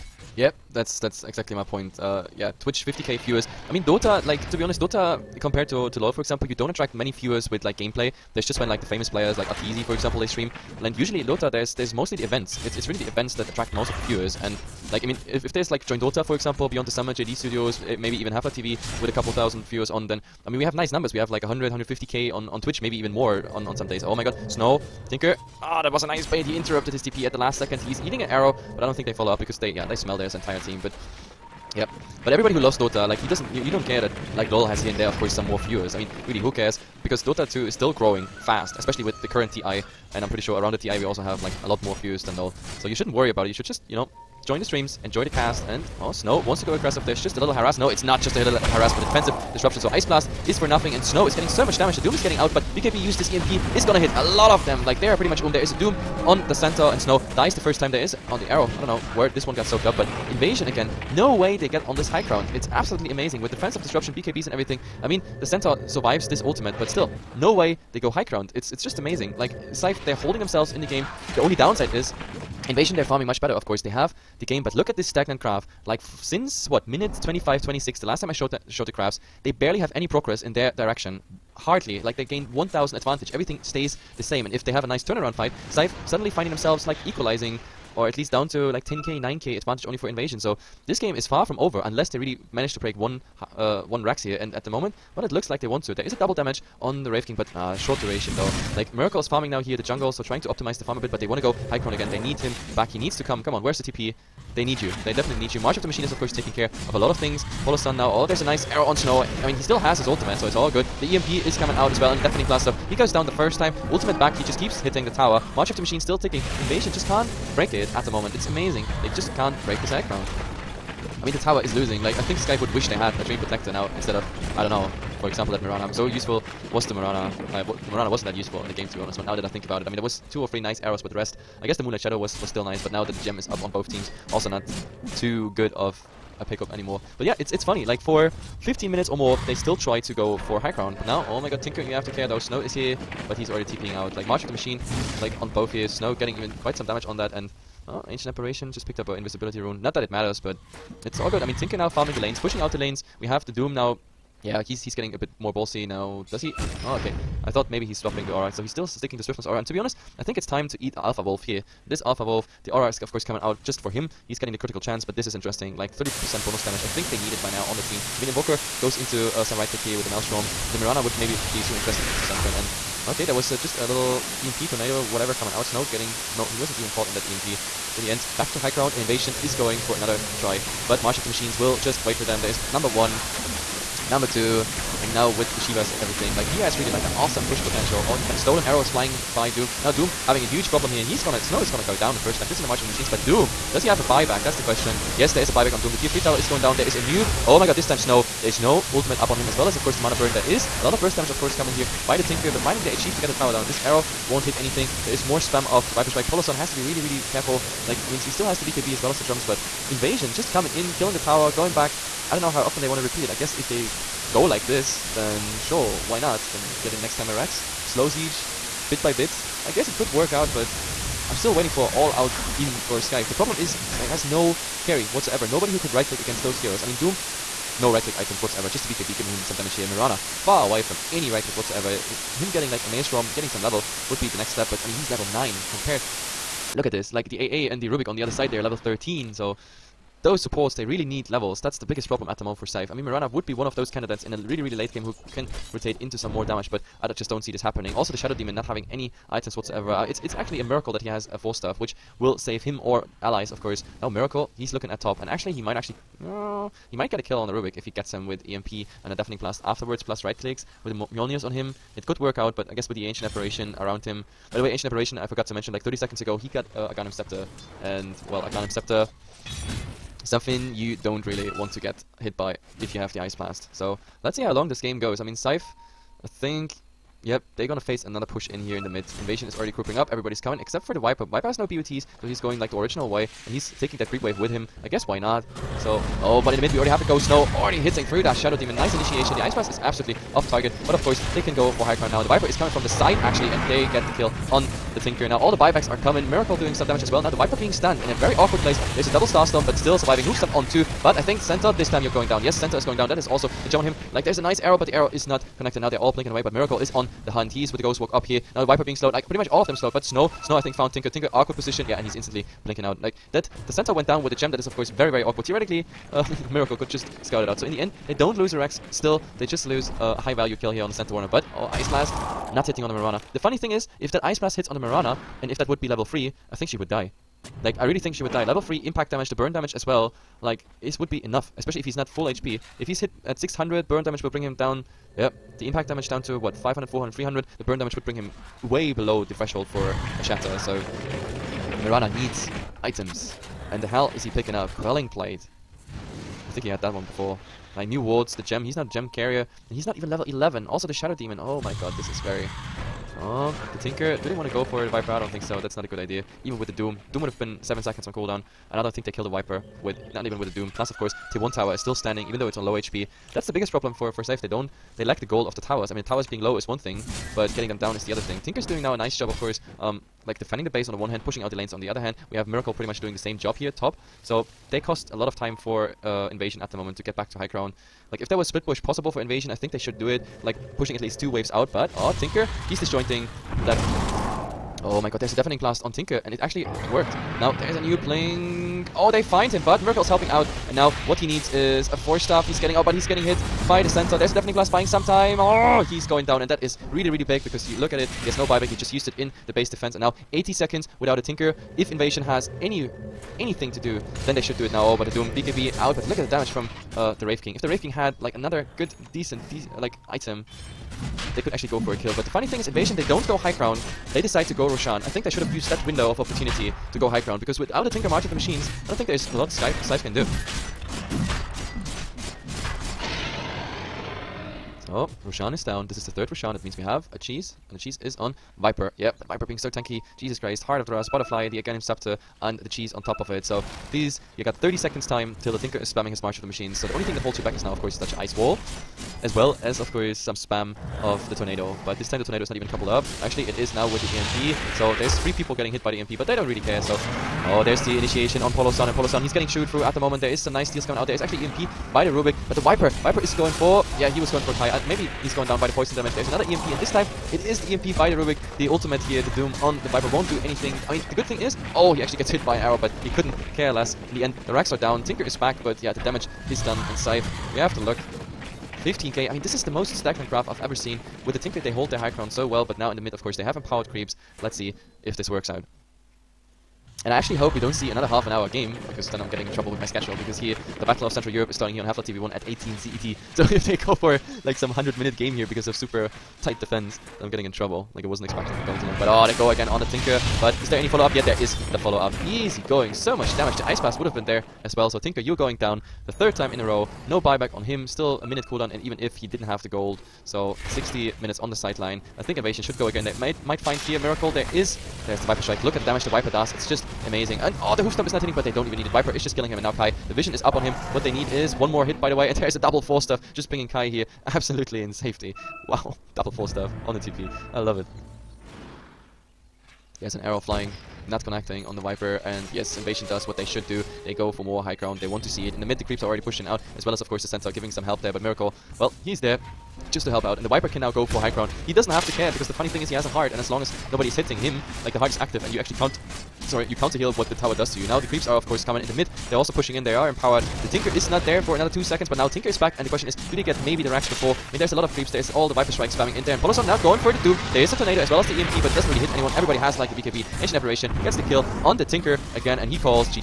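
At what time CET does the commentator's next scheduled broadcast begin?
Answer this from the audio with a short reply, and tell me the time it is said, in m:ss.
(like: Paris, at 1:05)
18 CET, at 8:02.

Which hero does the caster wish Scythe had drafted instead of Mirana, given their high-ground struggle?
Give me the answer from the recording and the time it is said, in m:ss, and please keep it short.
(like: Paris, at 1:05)
Treant Protector, at 2:03.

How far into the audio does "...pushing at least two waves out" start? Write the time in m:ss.
6:20.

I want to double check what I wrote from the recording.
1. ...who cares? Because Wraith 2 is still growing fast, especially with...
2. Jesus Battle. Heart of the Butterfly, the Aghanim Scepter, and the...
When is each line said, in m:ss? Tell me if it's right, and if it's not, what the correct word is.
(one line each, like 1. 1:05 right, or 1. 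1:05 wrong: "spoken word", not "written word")
1. 0:36 wrong: "Dota", not "Wraith"
2. 7:10 wrong: "Christ", not "Battle".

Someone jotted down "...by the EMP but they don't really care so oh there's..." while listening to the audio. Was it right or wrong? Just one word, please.
right.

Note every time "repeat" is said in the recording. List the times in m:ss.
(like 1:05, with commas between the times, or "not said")
3:33.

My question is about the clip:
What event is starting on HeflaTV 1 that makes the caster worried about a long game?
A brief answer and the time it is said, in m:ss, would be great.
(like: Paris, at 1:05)
Battle of Central Europe, at 8:00.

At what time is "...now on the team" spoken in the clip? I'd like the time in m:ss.
2:47.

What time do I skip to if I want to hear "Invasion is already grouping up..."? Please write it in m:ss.
4:39.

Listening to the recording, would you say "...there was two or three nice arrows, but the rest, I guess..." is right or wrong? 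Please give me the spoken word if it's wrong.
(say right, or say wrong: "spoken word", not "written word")
right.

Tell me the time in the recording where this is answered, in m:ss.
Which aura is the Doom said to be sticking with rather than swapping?
2:39.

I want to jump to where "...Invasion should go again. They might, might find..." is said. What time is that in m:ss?
8:22.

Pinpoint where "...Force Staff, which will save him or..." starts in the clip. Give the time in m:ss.
4:11.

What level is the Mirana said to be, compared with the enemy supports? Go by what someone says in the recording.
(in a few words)
9.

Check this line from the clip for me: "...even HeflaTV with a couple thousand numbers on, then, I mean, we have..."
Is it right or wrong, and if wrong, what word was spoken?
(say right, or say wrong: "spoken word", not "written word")
wrong: "viewers", not "numbers".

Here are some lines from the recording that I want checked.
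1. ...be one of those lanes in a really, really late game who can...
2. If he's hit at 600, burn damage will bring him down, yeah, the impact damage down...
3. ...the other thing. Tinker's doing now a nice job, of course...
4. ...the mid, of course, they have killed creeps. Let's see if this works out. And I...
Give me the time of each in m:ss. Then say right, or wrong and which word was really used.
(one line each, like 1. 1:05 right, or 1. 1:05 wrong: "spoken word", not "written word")
1. 4:03 wrong: "candidates", not "lanes"
2. 5:32 right
3. 6:08 right
4. 7:52 wrong: "empowered", not "killed".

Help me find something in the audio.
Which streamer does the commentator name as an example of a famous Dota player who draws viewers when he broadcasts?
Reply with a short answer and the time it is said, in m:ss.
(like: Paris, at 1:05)
Arteezy, at 0:09.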